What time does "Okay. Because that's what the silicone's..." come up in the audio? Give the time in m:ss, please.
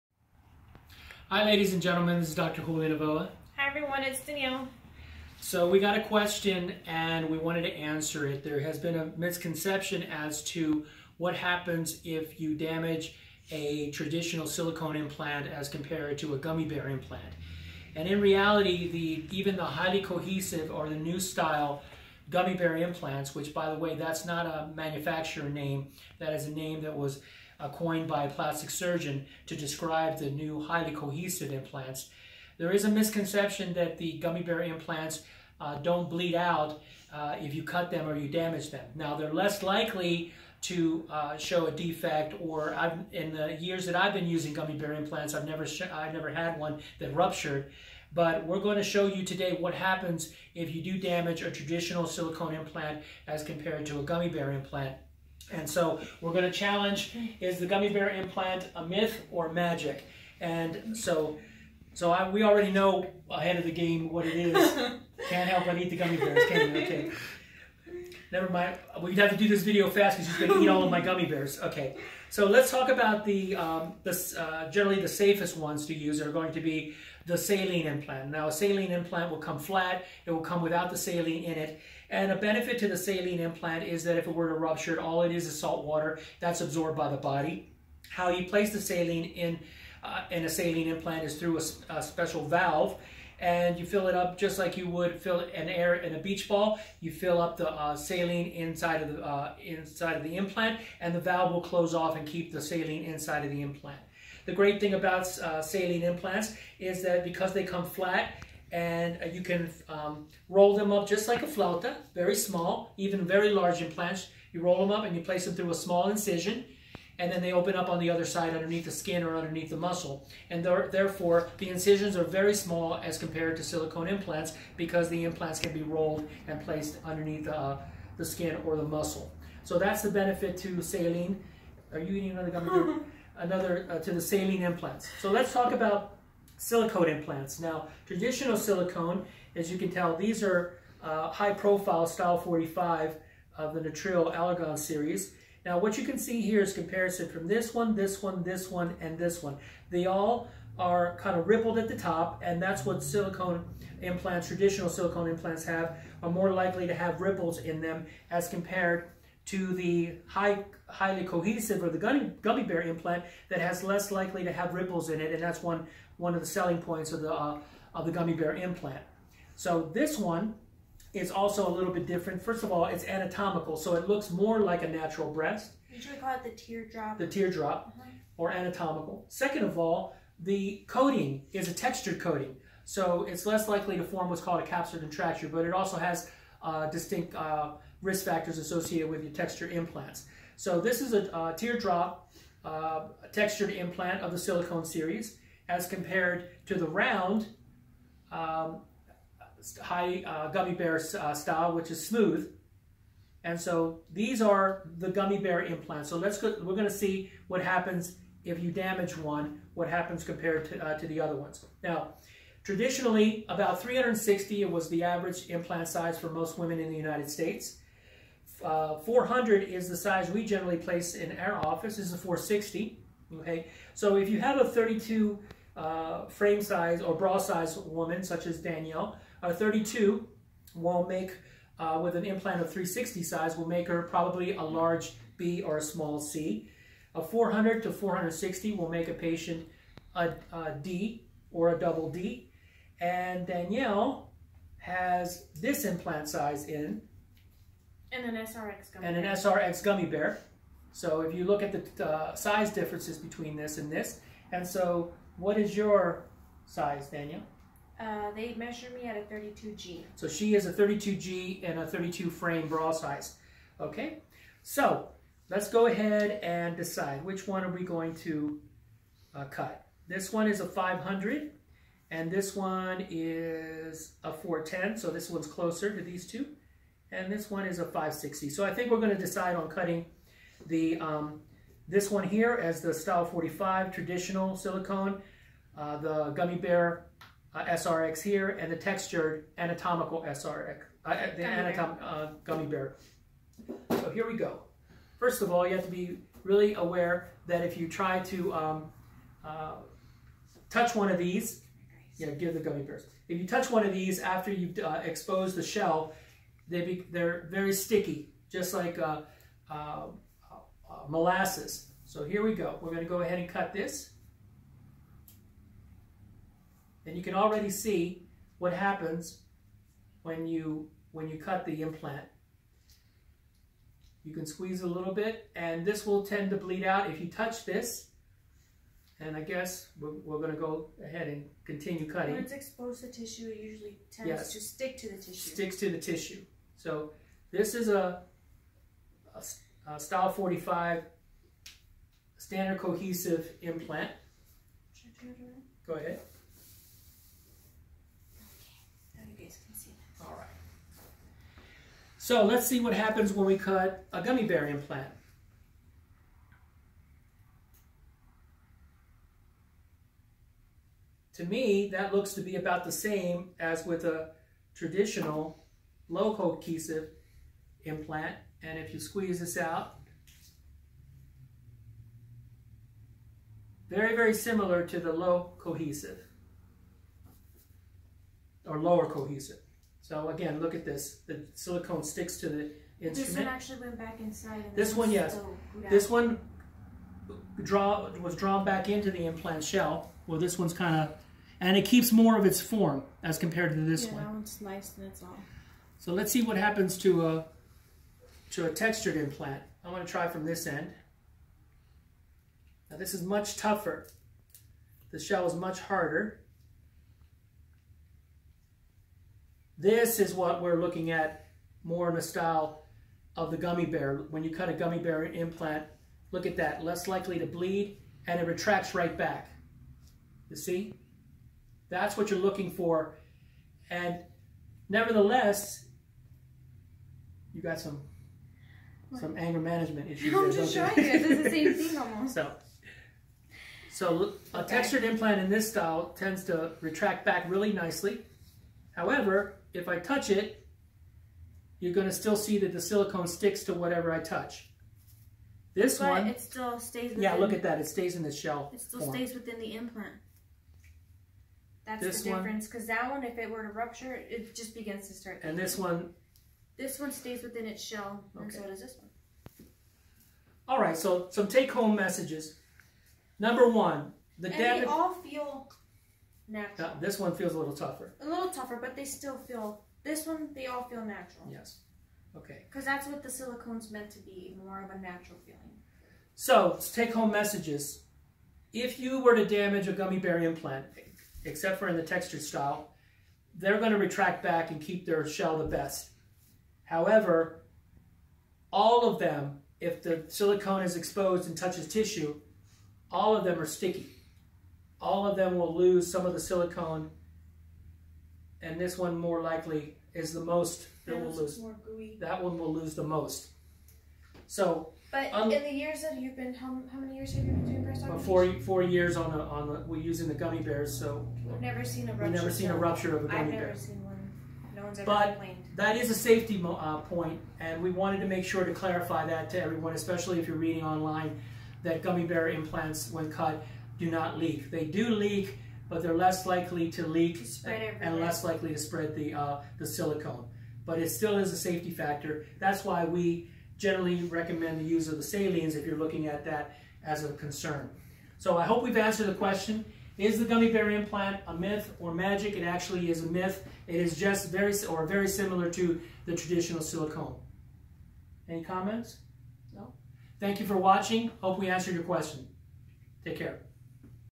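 7:52.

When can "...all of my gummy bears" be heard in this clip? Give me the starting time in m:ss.
1:10.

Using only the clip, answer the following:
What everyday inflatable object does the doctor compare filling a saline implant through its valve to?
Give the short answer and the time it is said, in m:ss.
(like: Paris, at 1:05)
A beach ball, at 1:36.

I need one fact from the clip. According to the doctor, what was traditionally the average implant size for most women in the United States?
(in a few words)
360.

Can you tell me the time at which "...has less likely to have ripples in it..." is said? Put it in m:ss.
2:43.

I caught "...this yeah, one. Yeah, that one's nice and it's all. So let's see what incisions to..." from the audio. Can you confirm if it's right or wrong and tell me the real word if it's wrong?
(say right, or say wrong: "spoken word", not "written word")
wrong: "happens", not "incisions".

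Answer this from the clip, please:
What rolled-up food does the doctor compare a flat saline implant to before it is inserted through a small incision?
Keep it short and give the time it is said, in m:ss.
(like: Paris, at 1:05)
A flauta, at 1:51.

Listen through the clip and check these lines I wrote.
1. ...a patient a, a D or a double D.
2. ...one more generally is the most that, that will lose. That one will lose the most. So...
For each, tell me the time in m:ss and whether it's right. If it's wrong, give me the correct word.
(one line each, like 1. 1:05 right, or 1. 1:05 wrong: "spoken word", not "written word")
1. 3:59 right
2. 8:18 wrong: "likely", not "generally".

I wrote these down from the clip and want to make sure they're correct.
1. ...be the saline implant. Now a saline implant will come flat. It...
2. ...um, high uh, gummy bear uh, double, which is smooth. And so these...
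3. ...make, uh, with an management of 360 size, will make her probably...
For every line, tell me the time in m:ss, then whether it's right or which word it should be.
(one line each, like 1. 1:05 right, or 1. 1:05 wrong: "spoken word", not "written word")
1. 1:16 right
2. 3:18 wrong: "style", not "double"
3. 3:51 wrong: "implant", not "management".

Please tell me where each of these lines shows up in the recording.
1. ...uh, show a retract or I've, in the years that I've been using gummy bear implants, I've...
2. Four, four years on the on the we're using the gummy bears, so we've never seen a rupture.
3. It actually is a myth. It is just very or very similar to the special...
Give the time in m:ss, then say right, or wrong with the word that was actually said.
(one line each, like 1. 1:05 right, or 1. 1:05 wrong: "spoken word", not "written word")
1. 0:41 wrong: "defect", not "retract"
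2. 8:28 right
3. 9:02 wrong: "traditional", not "special".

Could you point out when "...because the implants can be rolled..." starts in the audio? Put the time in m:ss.
2:04.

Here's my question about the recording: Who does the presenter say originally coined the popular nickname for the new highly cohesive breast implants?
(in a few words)
A plastic surgeon.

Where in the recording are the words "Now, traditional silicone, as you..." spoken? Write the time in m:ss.
2:17.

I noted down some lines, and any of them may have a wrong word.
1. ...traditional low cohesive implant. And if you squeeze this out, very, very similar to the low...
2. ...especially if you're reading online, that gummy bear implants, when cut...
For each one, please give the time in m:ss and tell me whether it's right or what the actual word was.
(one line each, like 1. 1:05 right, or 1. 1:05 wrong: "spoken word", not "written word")
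1. 6:04 right
2. 8:39 right.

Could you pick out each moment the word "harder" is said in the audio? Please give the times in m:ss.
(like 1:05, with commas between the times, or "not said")
6:45.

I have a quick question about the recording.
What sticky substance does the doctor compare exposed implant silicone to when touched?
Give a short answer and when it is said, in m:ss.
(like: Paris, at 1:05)
Molasses, at 5:11.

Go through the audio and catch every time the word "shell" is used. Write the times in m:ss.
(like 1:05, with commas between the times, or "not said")
5:05, 6:29, 6:45, 7:28, 7:37, 8:05.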